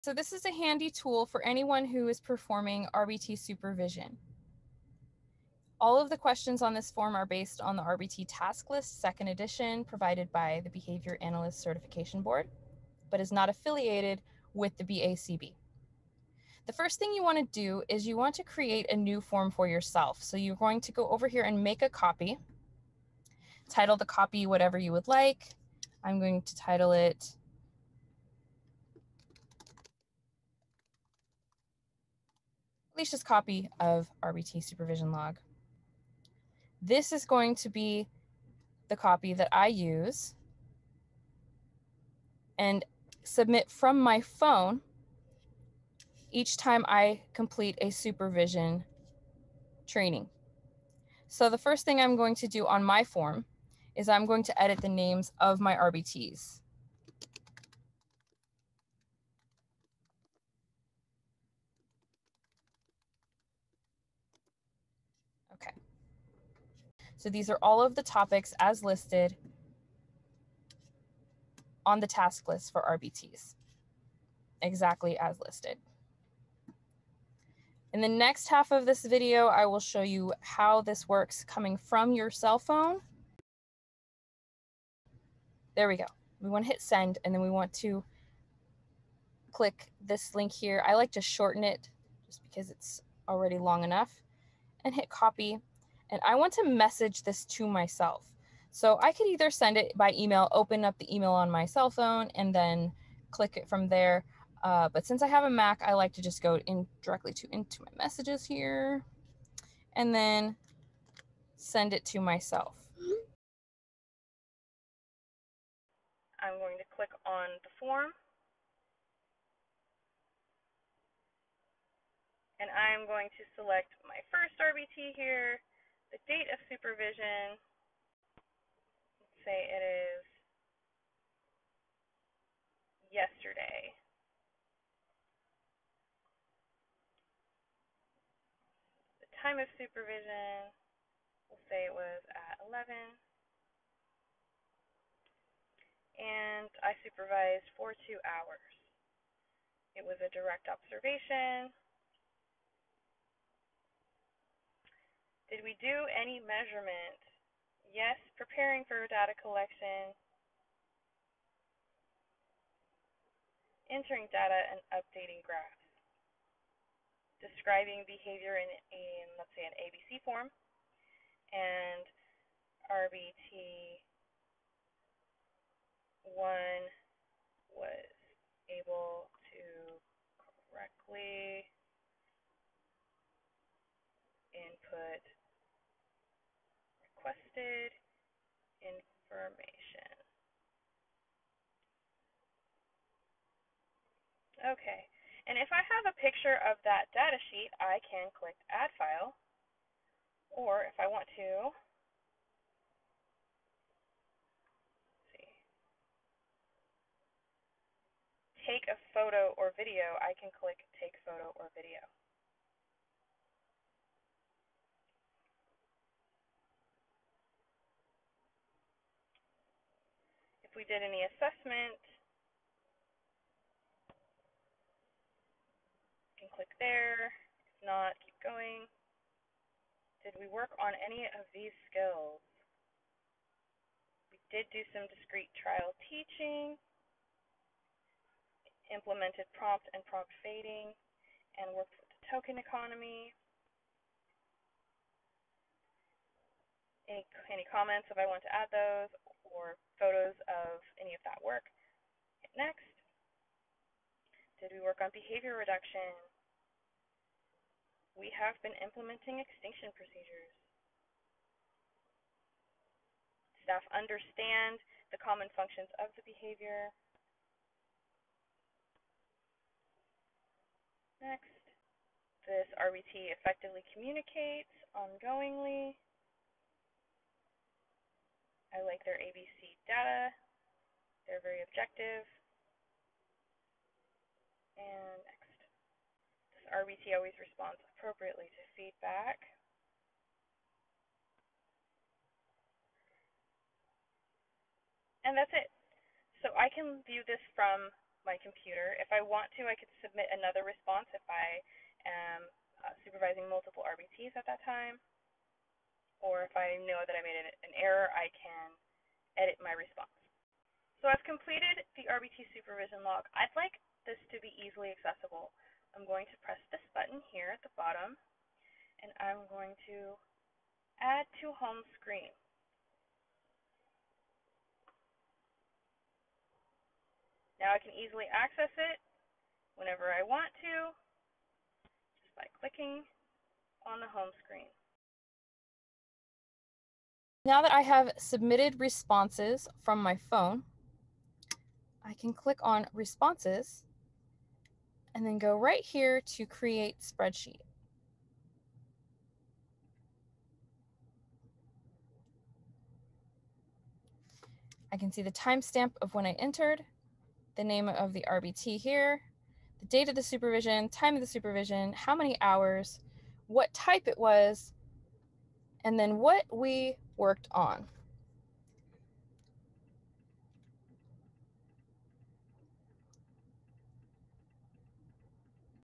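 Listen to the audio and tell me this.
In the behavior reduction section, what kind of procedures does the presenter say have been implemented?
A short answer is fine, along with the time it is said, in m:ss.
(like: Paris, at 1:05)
Extinction procedures, at 4:19.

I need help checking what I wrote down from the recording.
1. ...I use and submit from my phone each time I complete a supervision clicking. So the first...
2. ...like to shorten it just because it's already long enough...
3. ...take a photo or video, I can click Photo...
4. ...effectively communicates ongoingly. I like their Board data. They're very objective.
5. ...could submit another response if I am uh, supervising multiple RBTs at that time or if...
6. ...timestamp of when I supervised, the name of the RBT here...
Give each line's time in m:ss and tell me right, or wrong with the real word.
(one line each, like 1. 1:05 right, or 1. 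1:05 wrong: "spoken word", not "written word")
1. 0:39 wrong: "training", not "clicking"
2. 1:30 right
3. 3:28 wrong: "Take", not "Photo"
4. 4:33 wrong: "ABC", not "Board"
5. 4:59 right
6. 5:55 wrong: "entered", not "supervised".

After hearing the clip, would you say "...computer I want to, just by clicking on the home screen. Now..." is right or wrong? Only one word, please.
wrong.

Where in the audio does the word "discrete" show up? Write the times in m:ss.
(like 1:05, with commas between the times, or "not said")
3:55.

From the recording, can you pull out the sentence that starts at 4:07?
Any, any comments if I want to add those, or photos of any of that work.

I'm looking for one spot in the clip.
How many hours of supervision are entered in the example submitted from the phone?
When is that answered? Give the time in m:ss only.
2:28.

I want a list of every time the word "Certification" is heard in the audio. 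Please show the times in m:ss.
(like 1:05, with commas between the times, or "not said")
0:11.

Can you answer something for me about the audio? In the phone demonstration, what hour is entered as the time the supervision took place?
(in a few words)
11.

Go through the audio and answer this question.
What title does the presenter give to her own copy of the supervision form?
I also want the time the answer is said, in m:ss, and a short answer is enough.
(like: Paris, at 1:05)
Copy of RBT supervision log, at 0:33.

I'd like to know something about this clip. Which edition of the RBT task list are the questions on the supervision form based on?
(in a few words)
Second edition.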